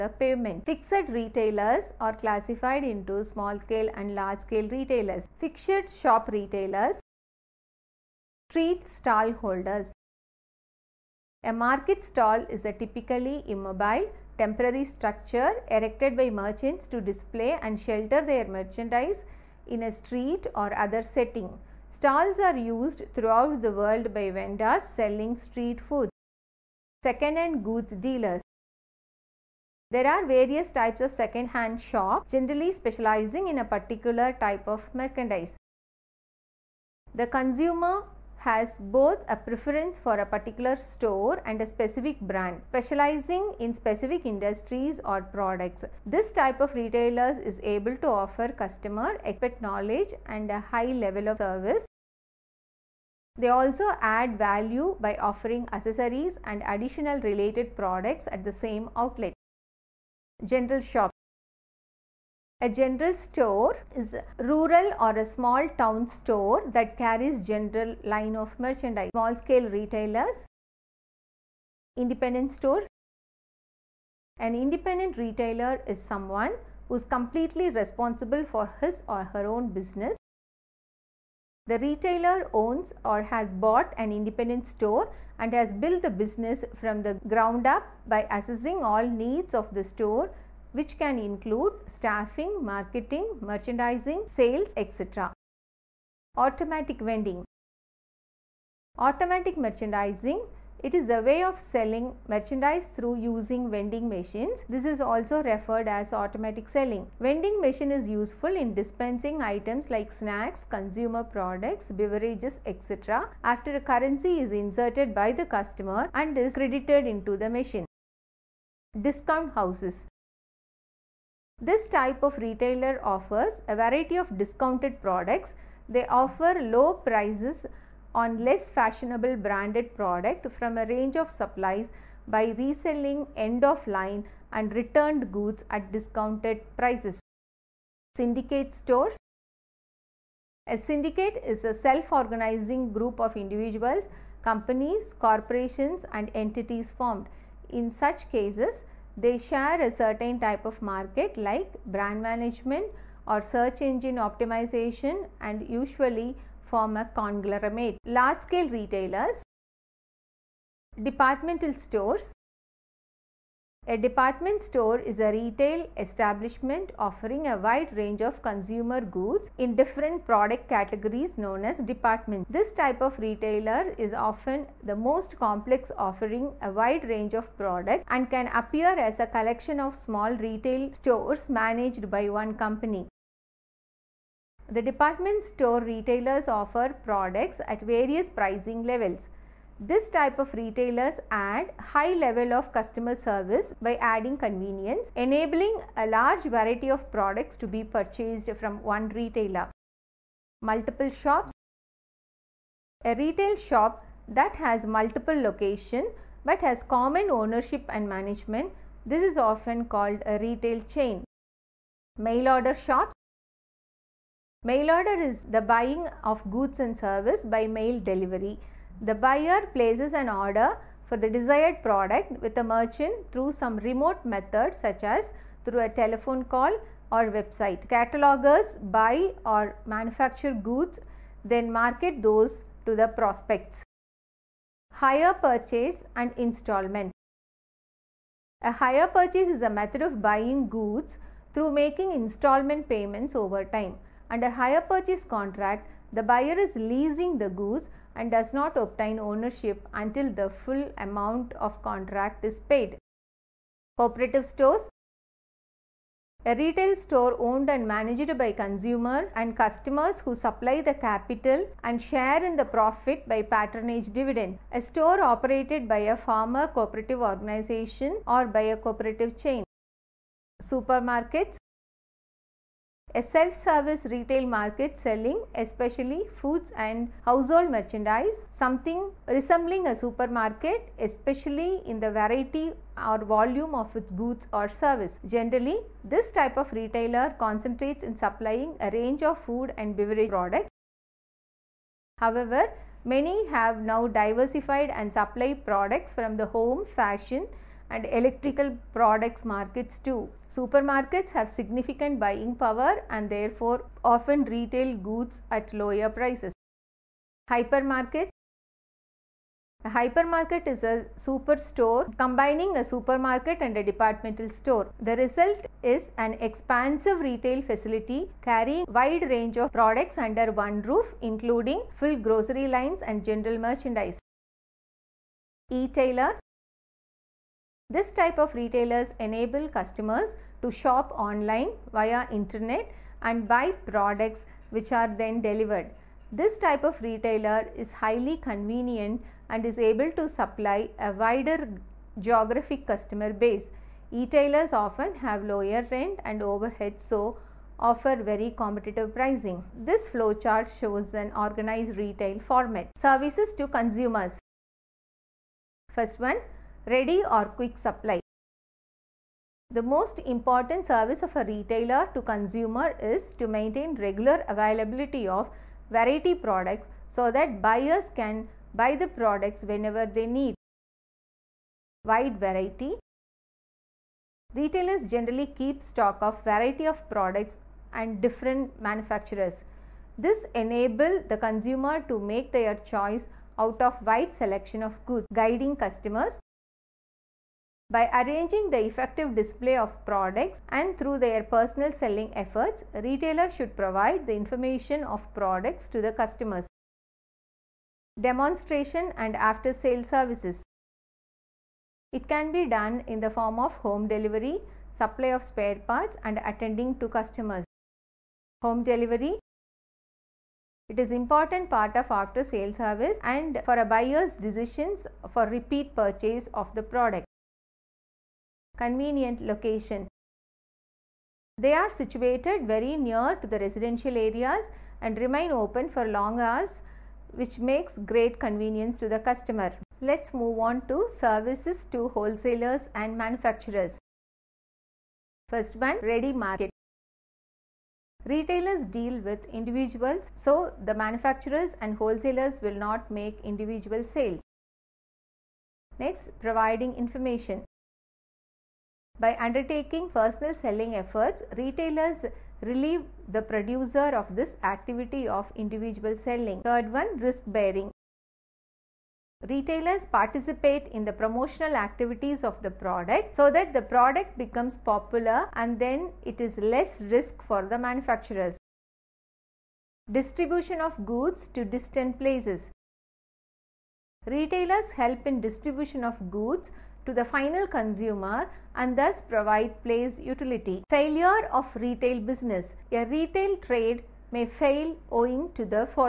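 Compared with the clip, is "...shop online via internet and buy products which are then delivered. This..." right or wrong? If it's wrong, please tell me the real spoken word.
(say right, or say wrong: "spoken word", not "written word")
right.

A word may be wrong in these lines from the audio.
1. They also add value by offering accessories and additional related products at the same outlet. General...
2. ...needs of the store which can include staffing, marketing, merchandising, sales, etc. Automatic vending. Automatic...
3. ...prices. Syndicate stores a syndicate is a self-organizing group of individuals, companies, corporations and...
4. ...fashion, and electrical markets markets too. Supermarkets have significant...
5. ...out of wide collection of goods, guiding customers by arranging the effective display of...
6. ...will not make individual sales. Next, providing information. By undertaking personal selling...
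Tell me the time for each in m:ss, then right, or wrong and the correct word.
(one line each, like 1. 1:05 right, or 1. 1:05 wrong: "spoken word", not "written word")
1. 0:53 right
2. 1:29 right
3. 2:16 right
4. 4:56 wrong: "products", not "markets"
5. 6:23 wrong: "selection", not "collection"
6. 7:22 right.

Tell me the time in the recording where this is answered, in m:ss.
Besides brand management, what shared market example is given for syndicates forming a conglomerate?
2:33.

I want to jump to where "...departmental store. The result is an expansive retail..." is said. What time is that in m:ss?
5:13.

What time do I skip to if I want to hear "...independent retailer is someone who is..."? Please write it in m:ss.
1:14.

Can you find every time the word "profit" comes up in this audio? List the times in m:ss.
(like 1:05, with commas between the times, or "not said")
4:22.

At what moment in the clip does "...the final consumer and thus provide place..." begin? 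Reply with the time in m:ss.
7:57.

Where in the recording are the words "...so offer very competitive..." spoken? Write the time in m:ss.
5:46.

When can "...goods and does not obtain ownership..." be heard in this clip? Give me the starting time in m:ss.
4:07.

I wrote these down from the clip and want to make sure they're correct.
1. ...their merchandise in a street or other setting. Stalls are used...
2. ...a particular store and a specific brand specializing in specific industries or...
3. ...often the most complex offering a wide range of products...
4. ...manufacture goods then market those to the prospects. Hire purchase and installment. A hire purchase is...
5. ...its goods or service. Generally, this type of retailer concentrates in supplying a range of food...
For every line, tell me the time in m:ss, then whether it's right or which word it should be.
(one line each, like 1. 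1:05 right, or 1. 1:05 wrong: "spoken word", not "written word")
1. 0:18 right
2. 0:40 right
3. 2:54 right
4. 3:49 right
5. 4:43 right.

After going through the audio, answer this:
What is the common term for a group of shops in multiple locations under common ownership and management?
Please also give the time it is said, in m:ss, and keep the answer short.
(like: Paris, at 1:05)
retail chain, at 3:30.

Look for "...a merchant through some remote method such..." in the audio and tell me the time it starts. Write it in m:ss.
3:42.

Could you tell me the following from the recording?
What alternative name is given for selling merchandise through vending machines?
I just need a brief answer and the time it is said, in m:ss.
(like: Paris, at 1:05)
automatic selling, at 1:46.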